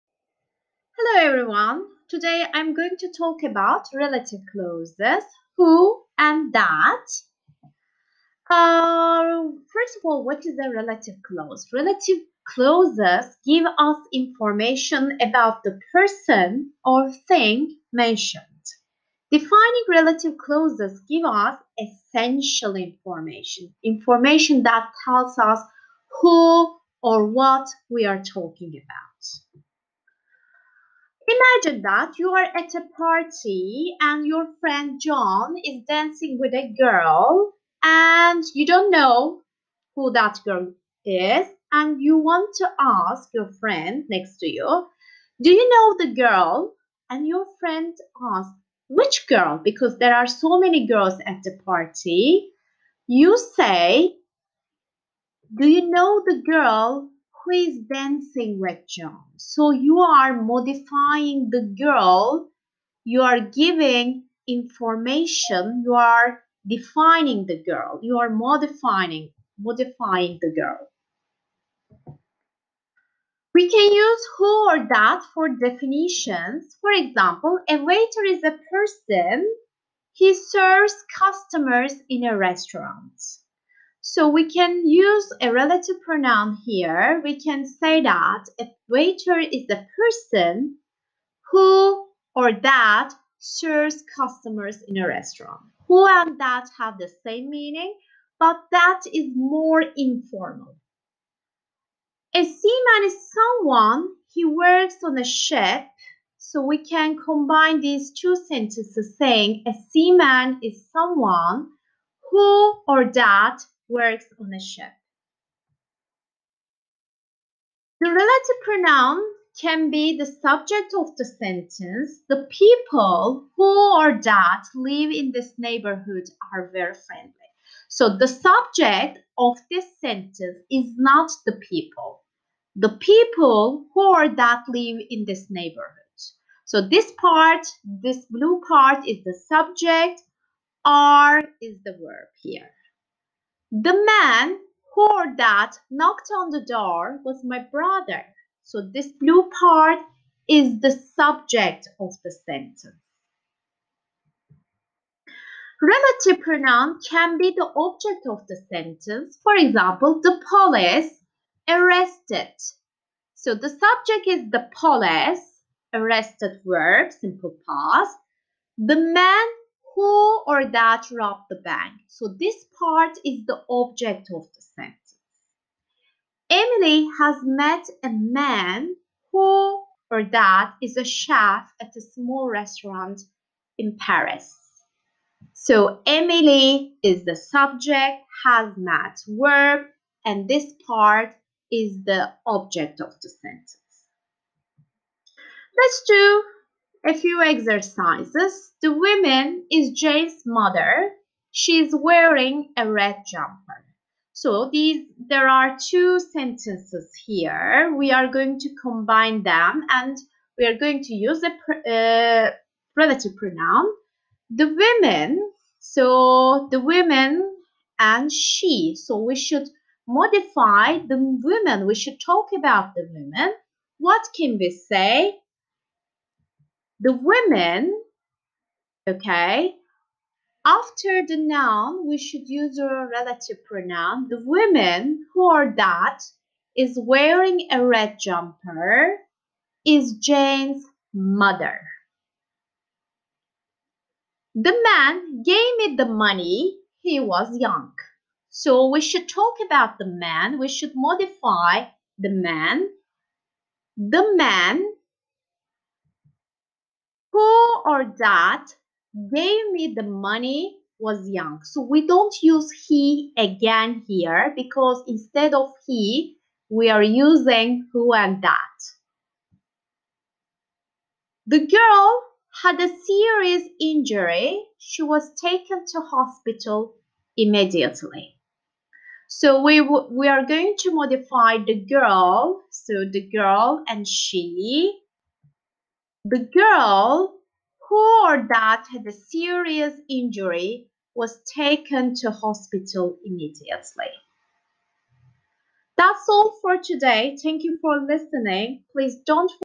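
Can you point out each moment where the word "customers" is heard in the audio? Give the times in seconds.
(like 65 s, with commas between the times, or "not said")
81 s, 94 s.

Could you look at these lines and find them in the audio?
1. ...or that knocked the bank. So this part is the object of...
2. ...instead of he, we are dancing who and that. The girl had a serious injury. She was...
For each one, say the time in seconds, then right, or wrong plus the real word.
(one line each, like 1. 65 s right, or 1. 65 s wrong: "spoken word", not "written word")
1. 170 s wrong: "robbed", not "knocked"
2. 265 s wrong: "using", not "dancing".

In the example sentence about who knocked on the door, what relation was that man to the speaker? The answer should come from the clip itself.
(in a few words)
Brother.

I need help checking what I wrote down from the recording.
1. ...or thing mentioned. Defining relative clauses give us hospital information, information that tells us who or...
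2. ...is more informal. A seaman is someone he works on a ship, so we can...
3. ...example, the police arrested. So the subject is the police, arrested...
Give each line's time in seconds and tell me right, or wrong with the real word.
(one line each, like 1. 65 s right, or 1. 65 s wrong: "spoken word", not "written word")
1. 16 s wrong: "essential", not "hospital"
2. 99 s right
3. 159 s right.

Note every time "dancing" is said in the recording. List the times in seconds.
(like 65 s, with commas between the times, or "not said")
35 s, 57 s.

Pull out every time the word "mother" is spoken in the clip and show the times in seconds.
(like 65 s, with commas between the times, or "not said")
200 s, 241 s.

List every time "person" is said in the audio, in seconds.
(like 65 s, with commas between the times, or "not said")
15 s, 78 s, 89 s.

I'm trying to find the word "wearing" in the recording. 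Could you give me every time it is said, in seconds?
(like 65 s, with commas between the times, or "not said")
201 s, 237 s.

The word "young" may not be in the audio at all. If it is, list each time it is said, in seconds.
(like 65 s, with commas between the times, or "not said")
247 s, 261 s.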